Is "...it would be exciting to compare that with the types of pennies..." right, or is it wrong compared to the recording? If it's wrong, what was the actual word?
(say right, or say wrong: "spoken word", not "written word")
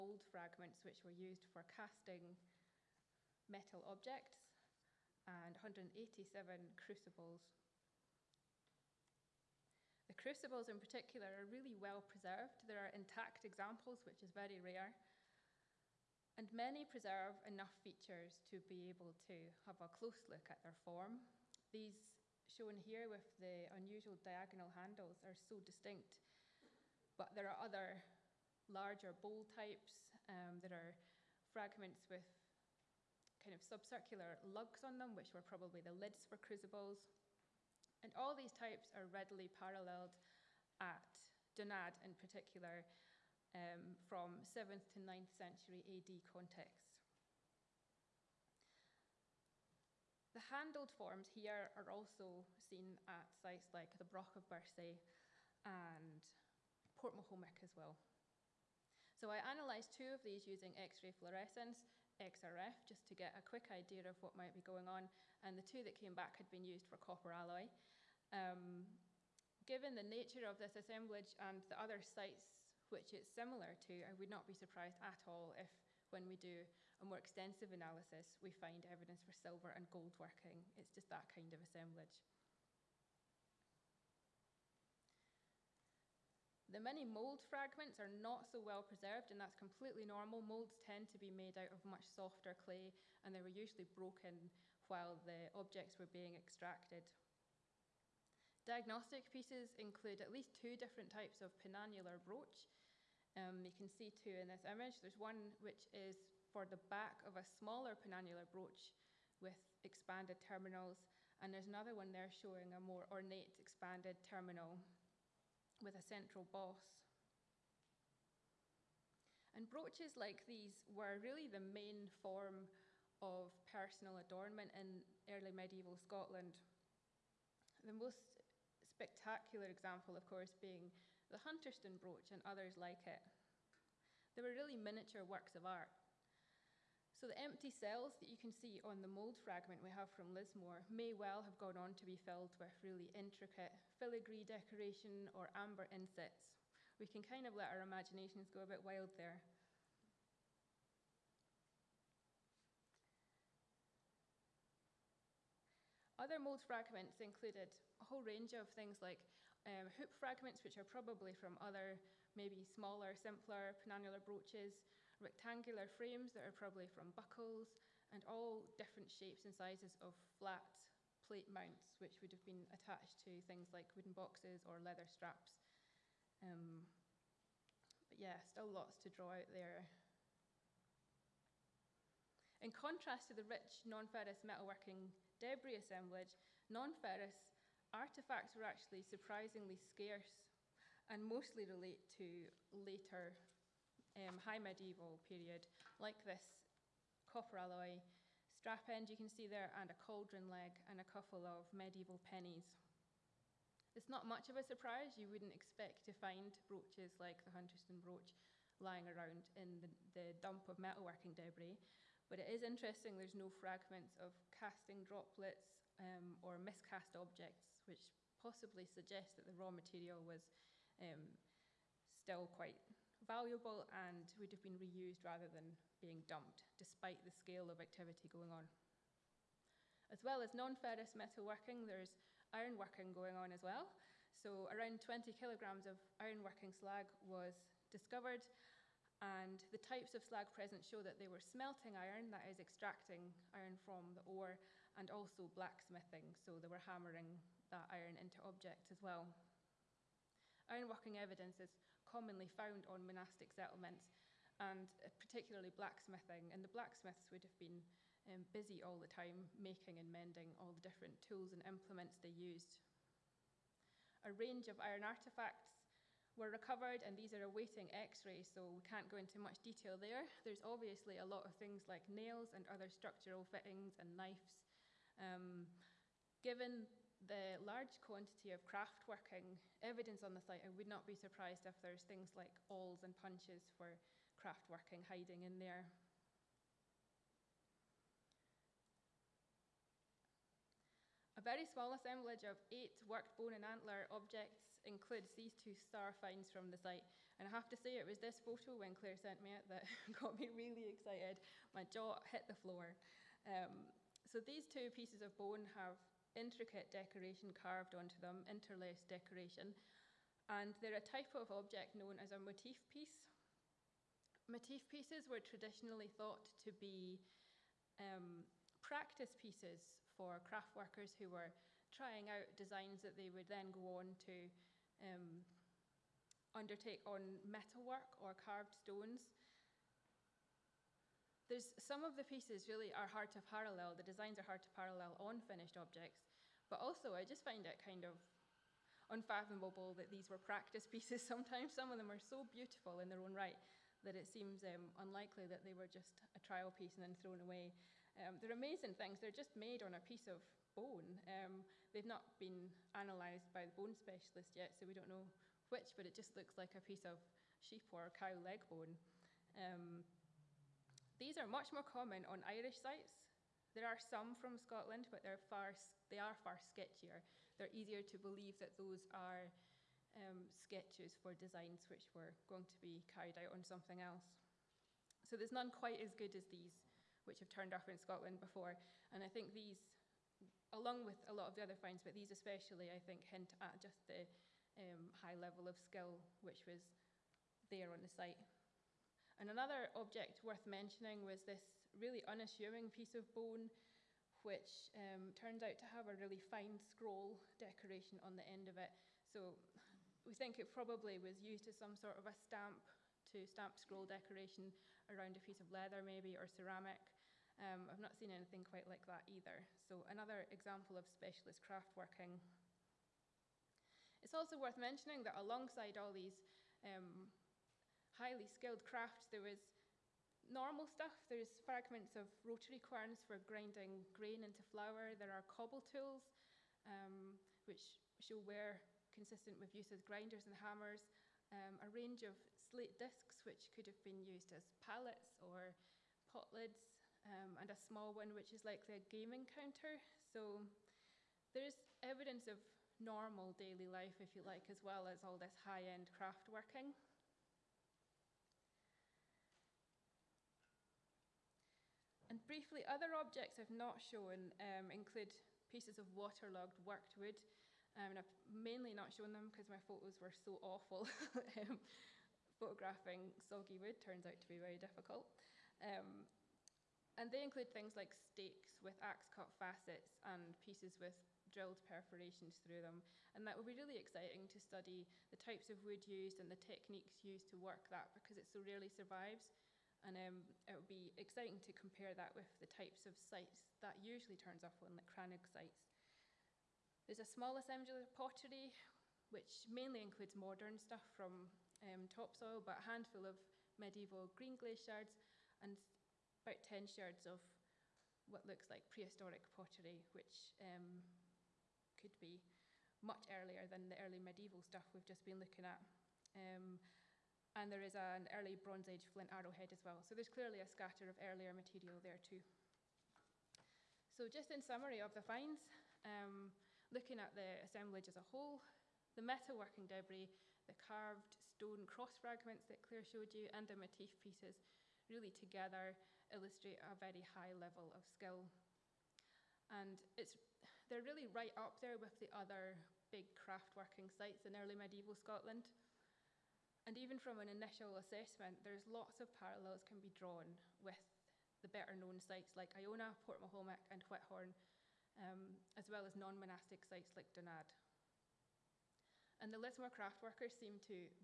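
wrong: "sites", not "pennies".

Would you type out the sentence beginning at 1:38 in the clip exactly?
Diagnostic pieces include at least two different types of penannular brooch.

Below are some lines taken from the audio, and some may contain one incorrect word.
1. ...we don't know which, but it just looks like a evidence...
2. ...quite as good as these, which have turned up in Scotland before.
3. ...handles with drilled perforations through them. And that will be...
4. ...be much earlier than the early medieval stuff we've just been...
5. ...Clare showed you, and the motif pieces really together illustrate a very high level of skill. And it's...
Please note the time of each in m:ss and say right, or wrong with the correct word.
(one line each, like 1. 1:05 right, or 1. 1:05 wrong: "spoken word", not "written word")
1. 5:54 wrong: "piece", not "evidence"
2. 6:15 right
3. 7:50 wrong: "pieces", not "handles"
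4. 8:22 right
5. 8:42 right.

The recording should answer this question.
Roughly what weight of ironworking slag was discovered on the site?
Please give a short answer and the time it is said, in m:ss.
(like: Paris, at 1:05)
20 kilograms, at 3:55.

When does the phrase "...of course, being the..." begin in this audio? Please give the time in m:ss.
2:10.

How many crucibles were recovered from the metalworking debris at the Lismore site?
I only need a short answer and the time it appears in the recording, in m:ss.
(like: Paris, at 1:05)
187, at 0:05.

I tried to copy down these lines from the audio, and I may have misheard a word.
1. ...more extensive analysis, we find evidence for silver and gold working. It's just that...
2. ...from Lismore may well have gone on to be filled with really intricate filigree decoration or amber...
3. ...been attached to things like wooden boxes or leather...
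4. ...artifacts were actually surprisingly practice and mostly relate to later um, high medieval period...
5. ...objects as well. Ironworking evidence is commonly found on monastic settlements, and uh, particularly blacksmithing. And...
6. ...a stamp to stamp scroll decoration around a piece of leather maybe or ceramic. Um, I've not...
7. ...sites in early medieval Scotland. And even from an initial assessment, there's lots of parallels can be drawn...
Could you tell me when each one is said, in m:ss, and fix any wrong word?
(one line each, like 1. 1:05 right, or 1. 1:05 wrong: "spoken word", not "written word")
1. 1:17 right
2. 2:20 right
3. 2:52 right
4. 3:07 wrong: "scarce", not "practice"
5. 4:08 right
6. 6:42 right
7. 8:54 right.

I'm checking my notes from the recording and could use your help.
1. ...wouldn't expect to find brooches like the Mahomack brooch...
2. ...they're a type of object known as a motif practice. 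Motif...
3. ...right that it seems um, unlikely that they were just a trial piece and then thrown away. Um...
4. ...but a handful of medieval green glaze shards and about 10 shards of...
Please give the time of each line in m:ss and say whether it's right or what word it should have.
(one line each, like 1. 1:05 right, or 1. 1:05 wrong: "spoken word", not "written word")
1. 3:25 wrong: "Hunterston", not "Mahomack"
2. 5:10 wrong: "piece", not "practice"
3. 5:43 right
4. 8:12 right.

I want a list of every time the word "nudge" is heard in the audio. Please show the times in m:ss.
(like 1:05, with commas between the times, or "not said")
not said.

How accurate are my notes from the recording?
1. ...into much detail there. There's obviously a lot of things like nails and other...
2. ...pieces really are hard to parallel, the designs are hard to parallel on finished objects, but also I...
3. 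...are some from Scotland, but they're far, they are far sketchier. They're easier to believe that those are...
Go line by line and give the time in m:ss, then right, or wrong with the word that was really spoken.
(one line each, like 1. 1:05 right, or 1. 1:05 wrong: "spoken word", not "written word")
1. 4:29 right
2. 5:32 right
3. 6:03 right.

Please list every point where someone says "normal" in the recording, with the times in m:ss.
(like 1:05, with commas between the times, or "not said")
1:30, 7:00, 7:22.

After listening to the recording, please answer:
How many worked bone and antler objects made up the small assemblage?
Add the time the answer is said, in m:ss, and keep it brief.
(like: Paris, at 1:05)
8, at 4:52.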